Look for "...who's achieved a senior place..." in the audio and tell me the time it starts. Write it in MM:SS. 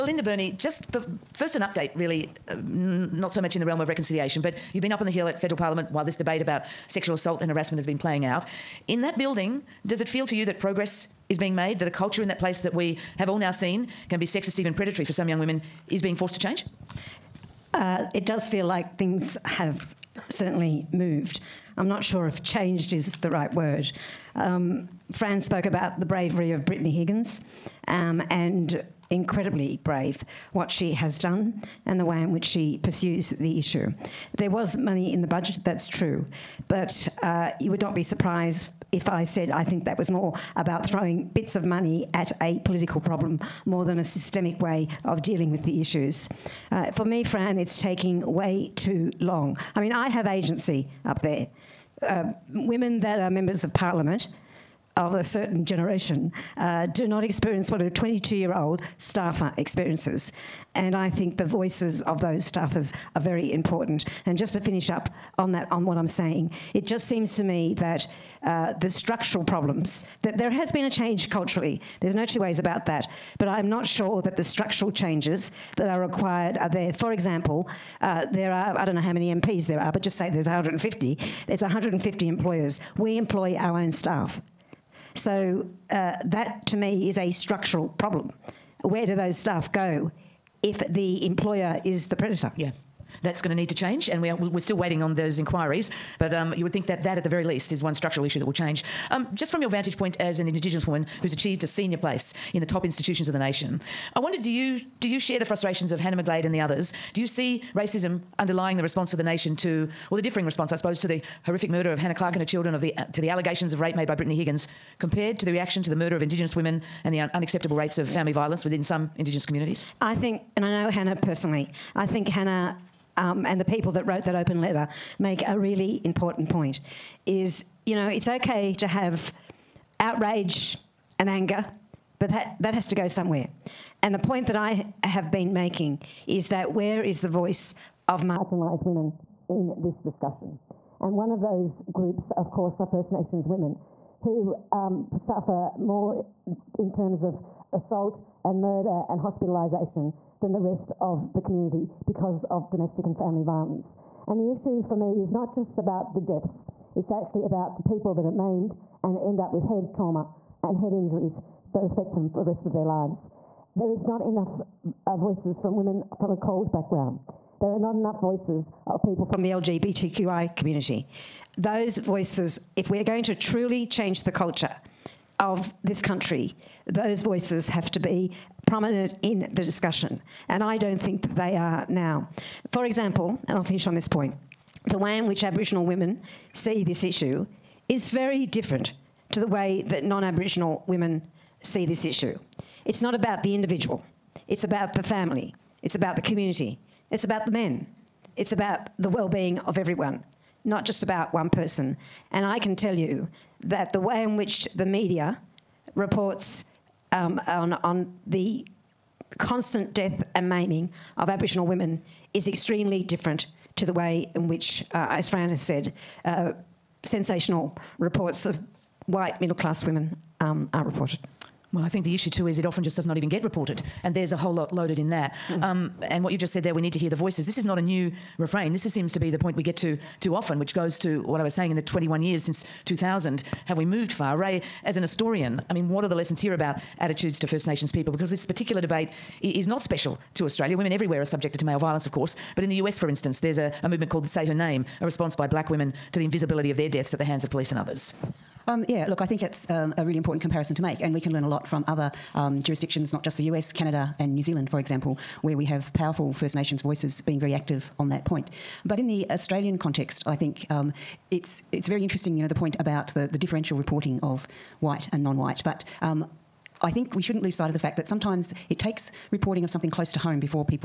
01:41.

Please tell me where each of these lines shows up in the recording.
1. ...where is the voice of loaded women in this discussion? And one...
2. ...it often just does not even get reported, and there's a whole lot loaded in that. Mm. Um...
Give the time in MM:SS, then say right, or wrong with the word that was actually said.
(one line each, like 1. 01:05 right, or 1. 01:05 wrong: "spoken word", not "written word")
1. 02:16 wrong: "marginalised", not "loaded"
2. 03:42 right.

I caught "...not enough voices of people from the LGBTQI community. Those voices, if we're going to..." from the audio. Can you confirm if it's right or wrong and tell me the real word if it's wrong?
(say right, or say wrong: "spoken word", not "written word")
right.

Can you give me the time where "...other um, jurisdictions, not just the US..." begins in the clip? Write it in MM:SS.
04:11.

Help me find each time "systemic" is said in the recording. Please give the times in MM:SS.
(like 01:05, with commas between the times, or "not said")
00:44.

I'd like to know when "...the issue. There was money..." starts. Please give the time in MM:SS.
00:33.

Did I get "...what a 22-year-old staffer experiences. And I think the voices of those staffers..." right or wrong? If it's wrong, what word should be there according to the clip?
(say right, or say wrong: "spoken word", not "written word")
right.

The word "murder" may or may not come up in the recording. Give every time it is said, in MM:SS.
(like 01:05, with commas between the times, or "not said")
01:51, 01:55, 02:28.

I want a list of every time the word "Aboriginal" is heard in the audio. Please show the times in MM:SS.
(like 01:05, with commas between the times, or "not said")
03:05, 03:10, 03:31.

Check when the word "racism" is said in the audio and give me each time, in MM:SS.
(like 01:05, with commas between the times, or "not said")
01:47.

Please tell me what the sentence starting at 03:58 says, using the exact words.
Because this particular debate is not special to Australia.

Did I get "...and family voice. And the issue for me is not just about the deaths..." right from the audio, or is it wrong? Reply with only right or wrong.
wrong.